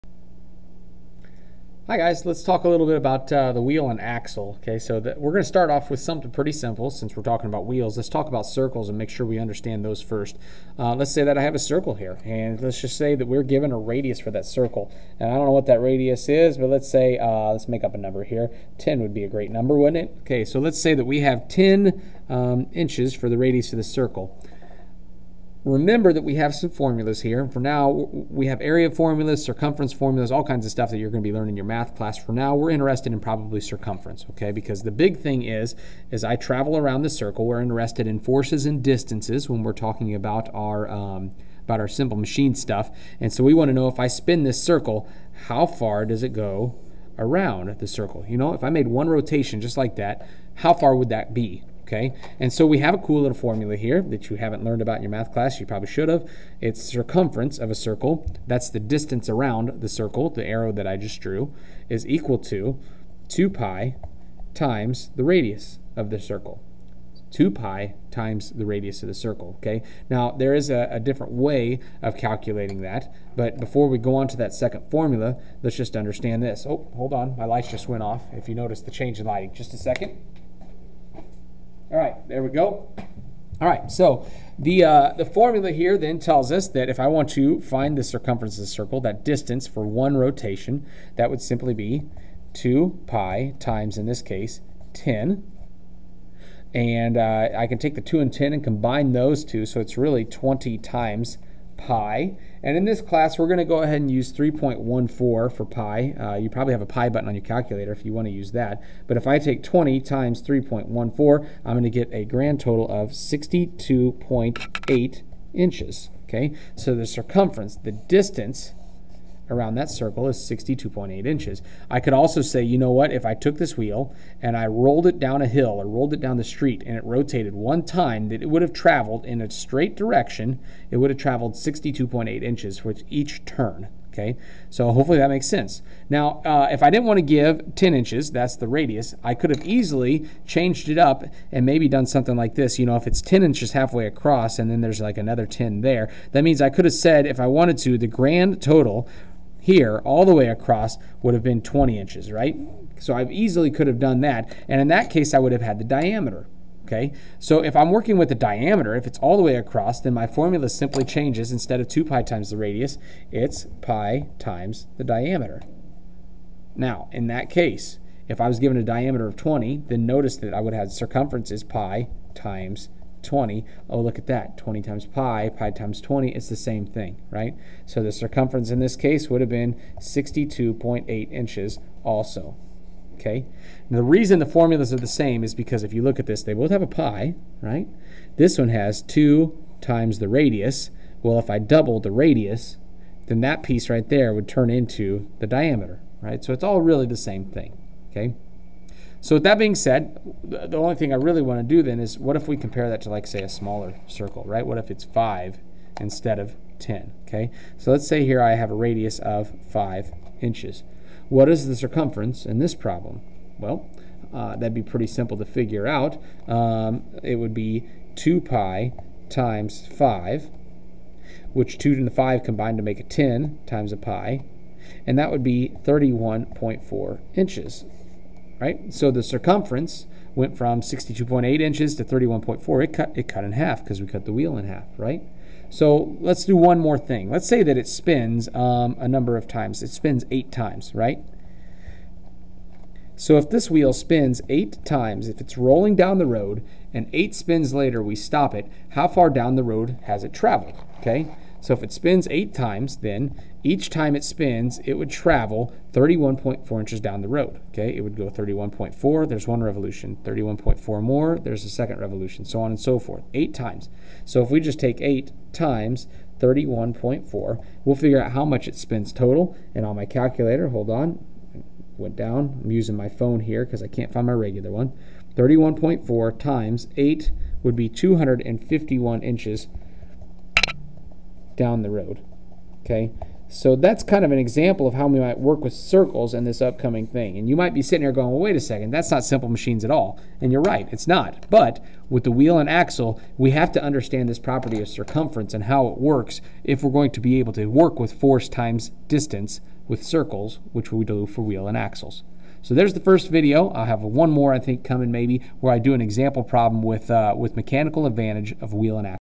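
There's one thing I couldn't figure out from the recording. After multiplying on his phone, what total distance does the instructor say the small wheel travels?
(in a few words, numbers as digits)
251 inches.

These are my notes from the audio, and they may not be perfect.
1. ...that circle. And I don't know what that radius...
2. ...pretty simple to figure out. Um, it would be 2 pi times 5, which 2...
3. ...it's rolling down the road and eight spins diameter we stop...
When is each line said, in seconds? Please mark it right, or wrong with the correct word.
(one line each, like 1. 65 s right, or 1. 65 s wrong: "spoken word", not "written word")
1. 14 s right
2. 214 s right
3. 245 s wrong: "later", not "diameter".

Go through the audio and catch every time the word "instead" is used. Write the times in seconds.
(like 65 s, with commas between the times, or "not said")
161 s, 205 s.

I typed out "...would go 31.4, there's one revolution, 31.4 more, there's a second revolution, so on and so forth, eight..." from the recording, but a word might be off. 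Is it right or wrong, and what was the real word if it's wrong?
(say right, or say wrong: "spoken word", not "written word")
right.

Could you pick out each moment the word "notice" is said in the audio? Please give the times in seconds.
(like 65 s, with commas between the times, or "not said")
78 s, 170 s.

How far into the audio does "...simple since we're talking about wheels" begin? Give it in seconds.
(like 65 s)
6 s.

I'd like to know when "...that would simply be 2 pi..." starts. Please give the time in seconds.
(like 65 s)
91 s.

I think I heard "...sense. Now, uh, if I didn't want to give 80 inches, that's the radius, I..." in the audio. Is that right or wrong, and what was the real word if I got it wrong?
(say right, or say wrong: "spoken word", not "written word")
wrong: "10", not "80".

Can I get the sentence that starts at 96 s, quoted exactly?
And uh, I can take the 2 and 10 and combine those two, so it's really 20 times pi.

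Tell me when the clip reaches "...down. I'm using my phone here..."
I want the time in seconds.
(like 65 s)
272 s.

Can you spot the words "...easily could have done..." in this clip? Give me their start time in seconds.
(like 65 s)
153 s.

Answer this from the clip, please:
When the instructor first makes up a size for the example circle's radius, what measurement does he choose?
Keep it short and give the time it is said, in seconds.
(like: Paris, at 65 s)
10 inches, at 21 s.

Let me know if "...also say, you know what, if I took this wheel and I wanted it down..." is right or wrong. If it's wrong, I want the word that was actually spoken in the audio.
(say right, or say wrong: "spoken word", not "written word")
wrong: "rolled", not "wanted".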